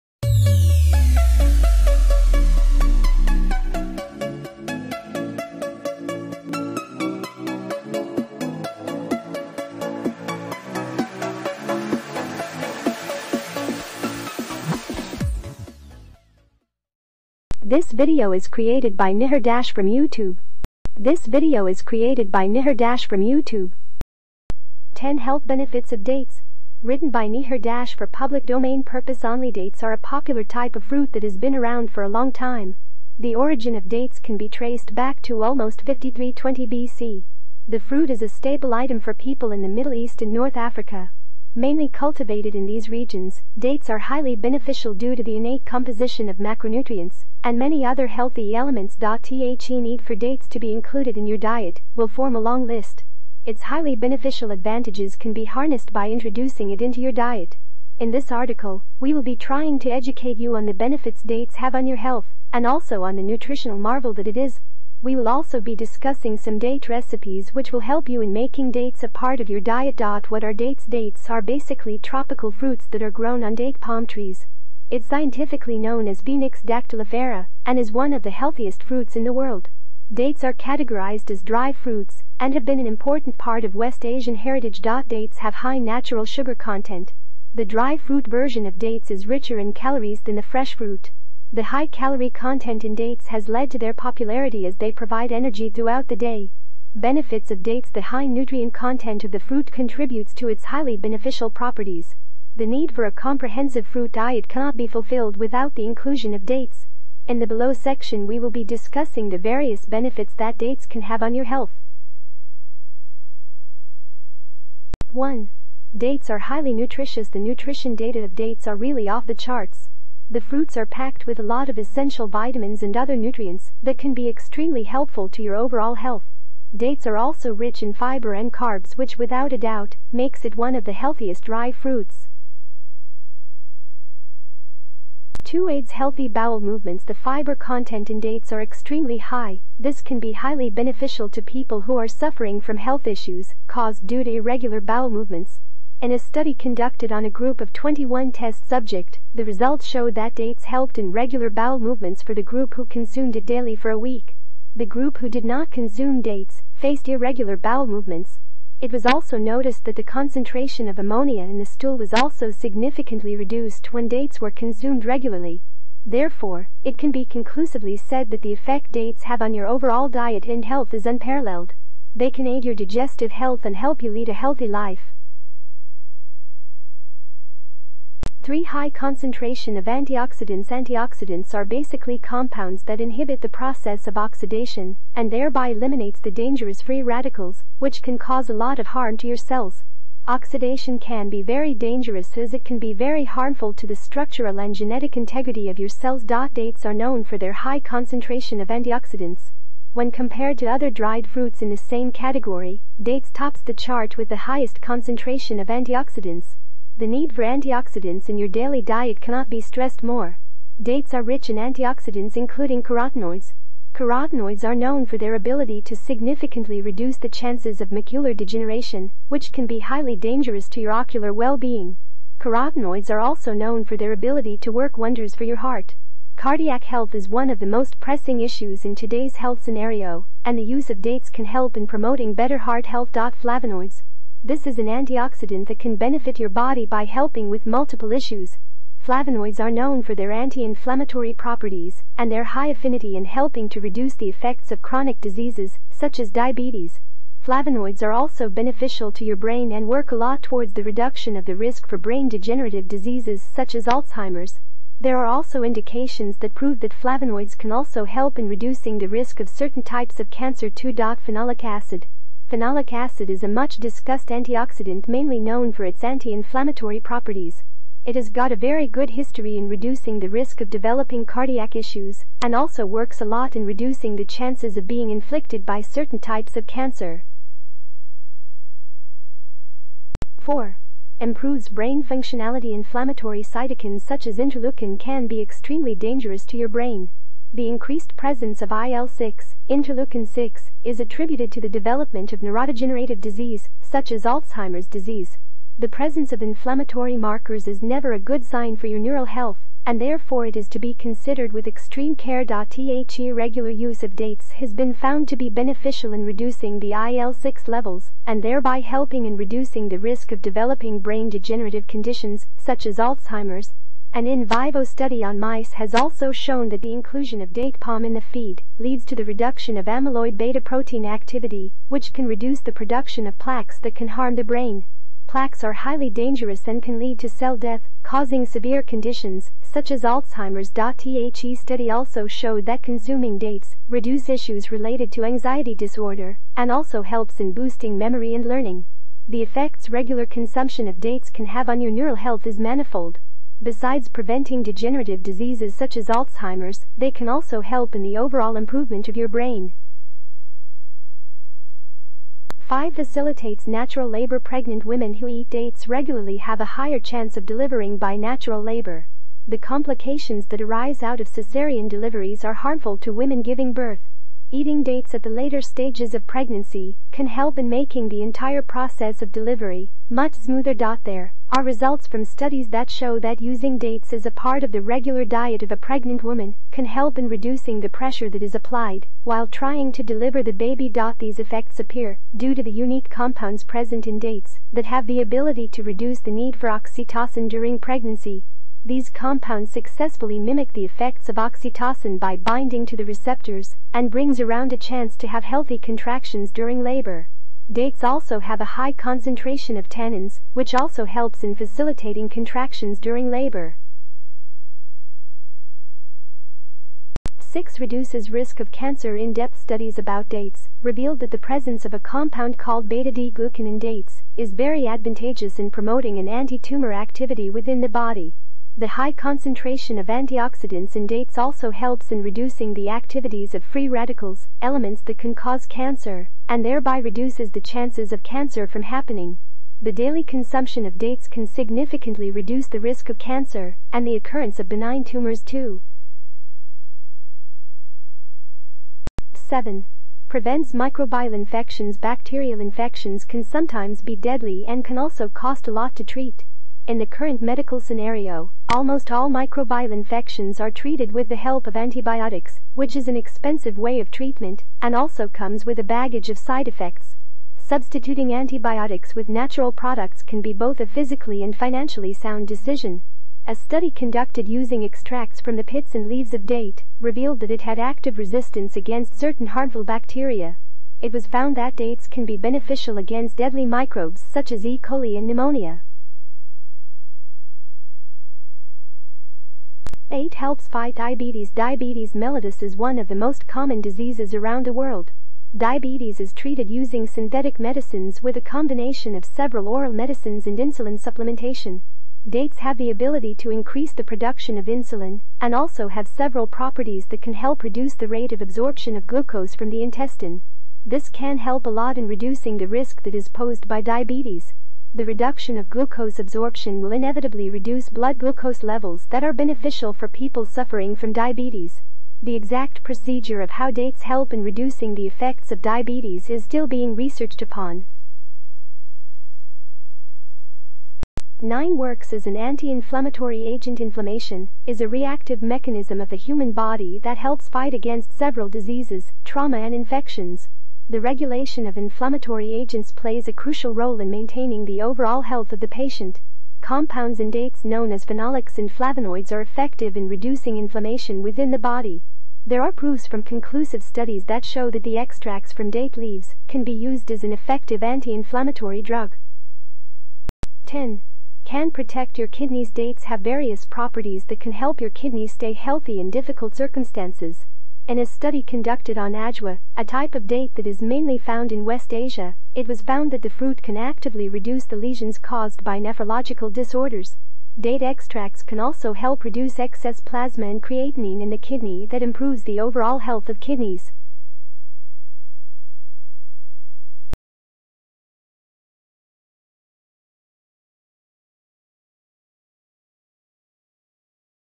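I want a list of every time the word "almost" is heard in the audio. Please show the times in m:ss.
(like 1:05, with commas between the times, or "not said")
0:35, 7:28.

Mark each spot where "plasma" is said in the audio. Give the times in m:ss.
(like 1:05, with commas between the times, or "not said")
9:29.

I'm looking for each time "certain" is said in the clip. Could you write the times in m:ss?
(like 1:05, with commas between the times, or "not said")
4:19, 4:35, 7:49.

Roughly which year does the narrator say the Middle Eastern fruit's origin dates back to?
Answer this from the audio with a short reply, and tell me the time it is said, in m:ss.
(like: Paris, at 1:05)
5320 BC, at 0:35.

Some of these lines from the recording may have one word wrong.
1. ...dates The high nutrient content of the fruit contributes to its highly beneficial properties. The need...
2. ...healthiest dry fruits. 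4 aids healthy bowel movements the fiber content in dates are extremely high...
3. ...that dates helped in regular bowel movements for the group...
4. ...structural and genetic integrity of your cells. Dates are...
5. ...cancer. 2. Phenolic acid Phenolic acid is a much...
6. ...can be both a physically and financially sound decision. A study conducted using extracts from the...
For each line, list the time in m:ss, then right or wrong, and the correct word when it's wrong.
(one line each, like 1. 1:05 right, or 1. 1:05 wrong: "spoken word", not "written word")
1. 1:37 right
2. 2:10 wrong: "2", not "4"
3. 2:30 right
4. 3:13 right
5. 4:20 right
6. 7:40 right.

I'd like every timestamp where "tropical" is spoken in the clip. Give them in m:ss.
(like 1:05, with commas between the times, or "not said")
1:11.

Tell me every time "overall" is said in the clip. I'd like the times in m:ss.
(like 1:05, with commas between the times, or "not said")
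2:05, 2:49, 5:48, 8:54, 9:32.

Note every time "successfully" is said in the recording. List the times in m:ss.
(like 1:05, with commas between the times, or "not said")
6:29.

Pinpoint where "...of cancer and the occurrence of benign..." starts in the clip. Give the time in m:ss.
7:13.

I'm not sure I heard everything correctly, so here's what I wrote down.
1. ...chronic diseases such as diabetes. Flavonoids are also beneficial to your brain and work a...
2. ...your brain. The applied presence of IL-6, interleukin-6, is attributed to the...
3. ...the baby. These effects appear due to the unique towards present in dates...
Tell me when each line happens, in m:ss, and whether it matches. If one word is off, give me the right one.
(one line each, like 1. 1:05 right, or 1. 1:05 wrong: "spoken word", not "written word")
1. 4:04 right
2. 4:46 wrong: "increased", not "applied"
3. 6:20 wrong: "compounds", not "towards".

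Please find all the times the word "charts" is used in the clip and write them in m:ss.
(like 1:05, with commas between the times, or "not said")
1:59, 3:23.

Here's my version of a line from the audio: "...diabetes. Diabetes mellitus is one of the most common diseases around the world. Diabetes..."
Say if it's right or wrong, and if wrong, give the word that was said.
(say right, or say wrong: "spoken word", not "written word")
right.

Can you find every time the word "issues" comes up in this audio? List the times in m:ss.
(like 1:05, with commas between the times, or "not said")
2:23, 3:48, 3:58, 4:31, 5:34.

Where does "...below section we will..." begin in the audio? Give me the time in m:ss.
1:47.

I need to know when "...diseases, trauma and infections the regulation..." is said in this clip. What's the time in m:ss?
8:48.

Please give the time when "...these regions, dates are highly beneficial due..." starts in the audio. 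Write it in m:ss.
0:42.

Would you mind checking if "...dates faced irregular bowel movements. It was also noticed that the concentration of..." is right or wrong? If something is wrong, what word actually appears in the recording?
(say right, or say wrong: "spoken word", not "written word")
right.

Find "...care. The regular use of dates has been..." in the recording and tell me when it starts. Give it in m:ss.
5:02.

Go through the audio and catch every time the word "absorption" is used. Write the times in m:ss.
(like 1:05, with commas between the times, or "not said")
8:18, 8:26.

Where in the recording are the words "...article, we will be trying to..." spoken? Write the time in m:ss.
0:58.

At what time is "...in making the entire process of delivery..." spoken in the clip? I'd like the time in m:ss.
6:07.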